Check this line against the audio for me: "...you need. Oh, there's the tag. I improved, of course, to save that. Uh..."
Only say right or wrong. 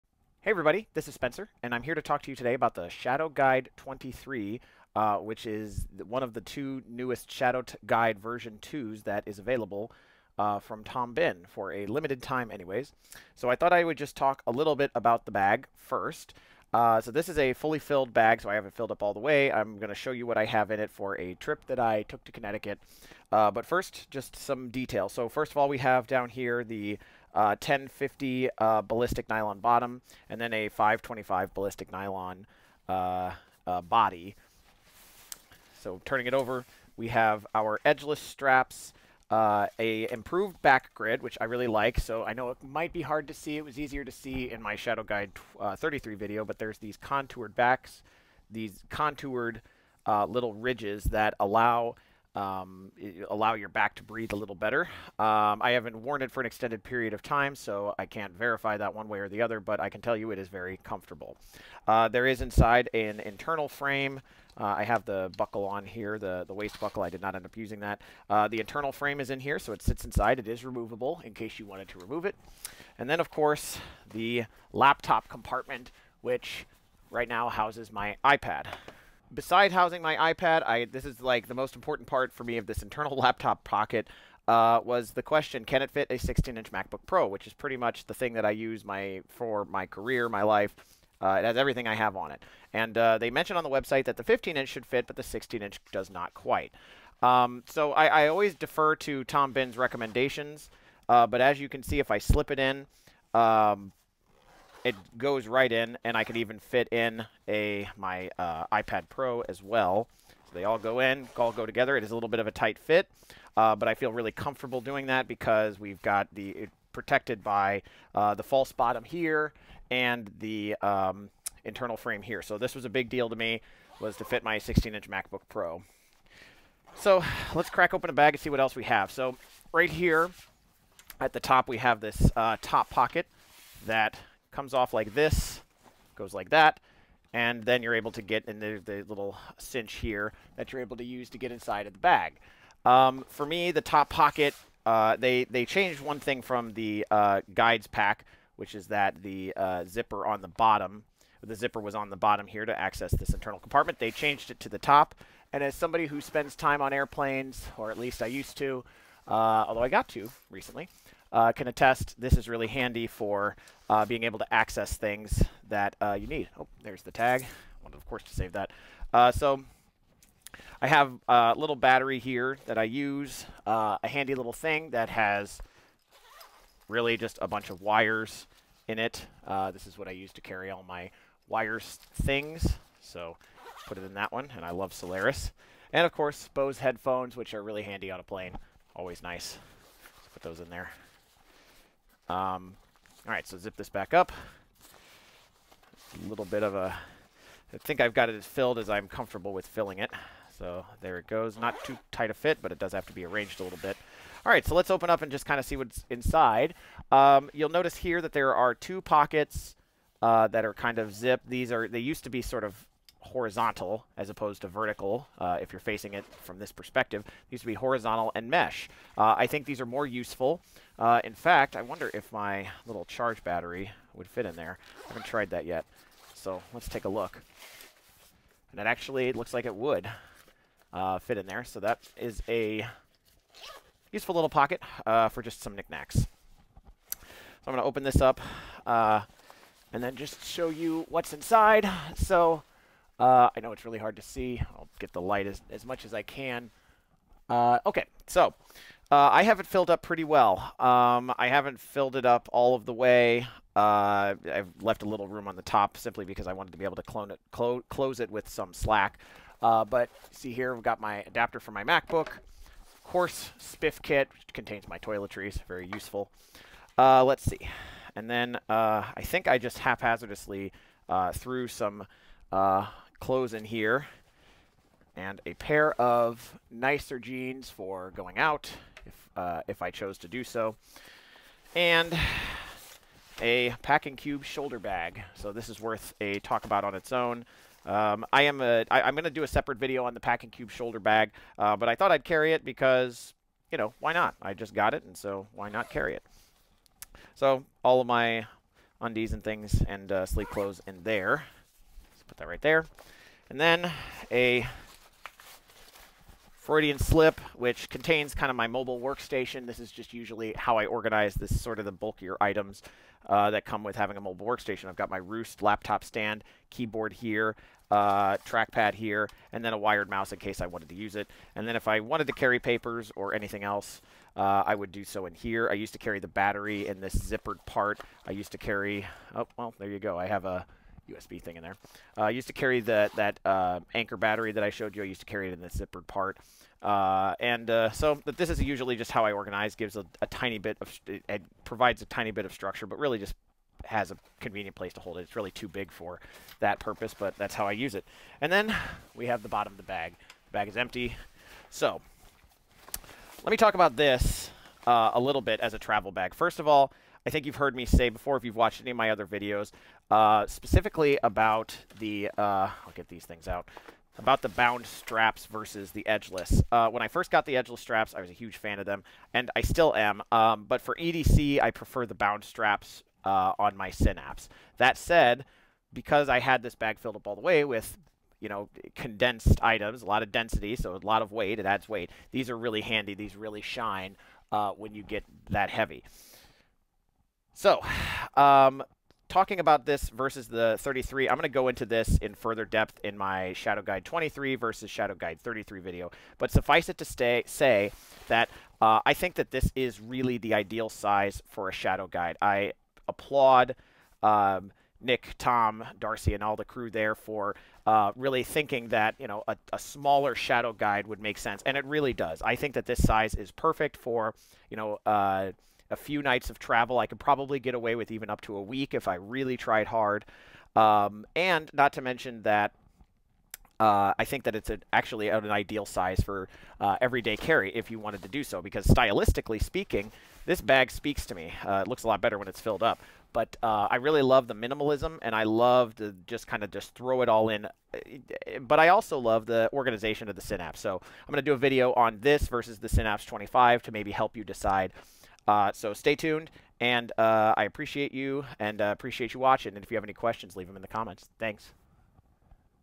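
wrong.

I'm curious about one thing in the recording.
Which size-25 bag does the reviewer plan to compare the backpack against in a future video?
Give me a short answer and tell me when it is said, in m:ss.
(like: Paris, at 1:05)
Synapse 25, at 7:22.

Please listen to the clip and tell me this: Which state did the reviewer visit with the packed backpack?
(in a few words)
Connecticut.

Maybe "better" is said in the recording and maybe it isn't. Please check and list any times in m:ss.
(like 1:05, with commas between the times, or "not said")
0:54, 7:12.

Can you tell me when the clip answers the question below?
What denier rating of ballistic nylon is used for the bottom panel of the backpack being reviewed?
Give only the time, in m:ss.
0:27.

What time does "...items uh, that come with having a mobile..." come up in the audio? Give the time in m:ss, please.
5:12.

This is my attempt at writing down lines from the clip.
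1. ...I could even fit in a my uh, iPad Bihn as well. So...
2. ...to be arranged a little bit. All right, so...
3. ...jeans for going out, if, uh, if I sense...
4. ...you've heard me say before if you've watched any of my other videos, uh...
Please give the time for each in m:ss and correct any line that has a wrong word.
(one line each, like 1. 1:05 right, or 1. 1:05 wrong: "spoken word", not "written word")
1. 1:46 wrong: "Pro", not "Bihn"
2. 3:23 right
3. 4:37 wrong: "chose", not "sense"
4. 5:57 right.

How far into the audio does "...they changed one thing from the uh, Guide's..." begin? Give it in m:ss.
2:25.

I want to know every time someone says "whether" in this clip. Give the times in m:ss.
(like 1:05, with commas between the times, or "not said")
not said.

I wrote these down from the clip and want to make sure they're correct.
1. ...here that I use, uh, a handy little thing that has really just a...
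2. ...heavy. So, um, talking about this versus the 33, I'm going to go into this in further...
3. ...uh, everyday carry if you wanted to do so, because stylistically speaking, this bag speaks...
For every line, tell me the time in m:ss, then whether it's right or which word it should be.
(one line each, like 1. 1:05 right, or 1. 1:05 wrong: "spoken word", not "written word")
1. 2:52 right
2. 6:25 right
3. 7:06 right.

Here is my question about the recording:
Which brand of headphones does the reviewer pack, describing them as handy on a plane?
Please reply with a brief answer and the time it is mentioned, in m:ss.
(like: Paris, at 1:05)
Bose, at 3:06.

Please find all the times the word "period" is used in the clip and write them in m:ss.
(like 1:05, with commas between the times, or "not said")
0:56.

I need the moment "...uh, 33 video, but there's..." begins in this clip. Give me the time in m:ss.
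0:45.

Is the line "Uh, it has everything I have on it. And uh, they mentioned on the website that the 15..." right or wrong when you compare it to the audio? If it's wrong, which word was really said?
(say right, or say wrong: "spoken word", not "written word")
right.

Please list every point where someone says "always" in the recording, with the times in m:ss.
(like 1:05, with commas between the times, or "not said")
1:38, 3:08.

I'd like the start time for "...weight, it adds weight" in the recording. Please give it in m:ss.
6:21.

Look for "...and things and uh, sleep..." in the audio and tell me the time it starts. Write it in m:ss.
4:59.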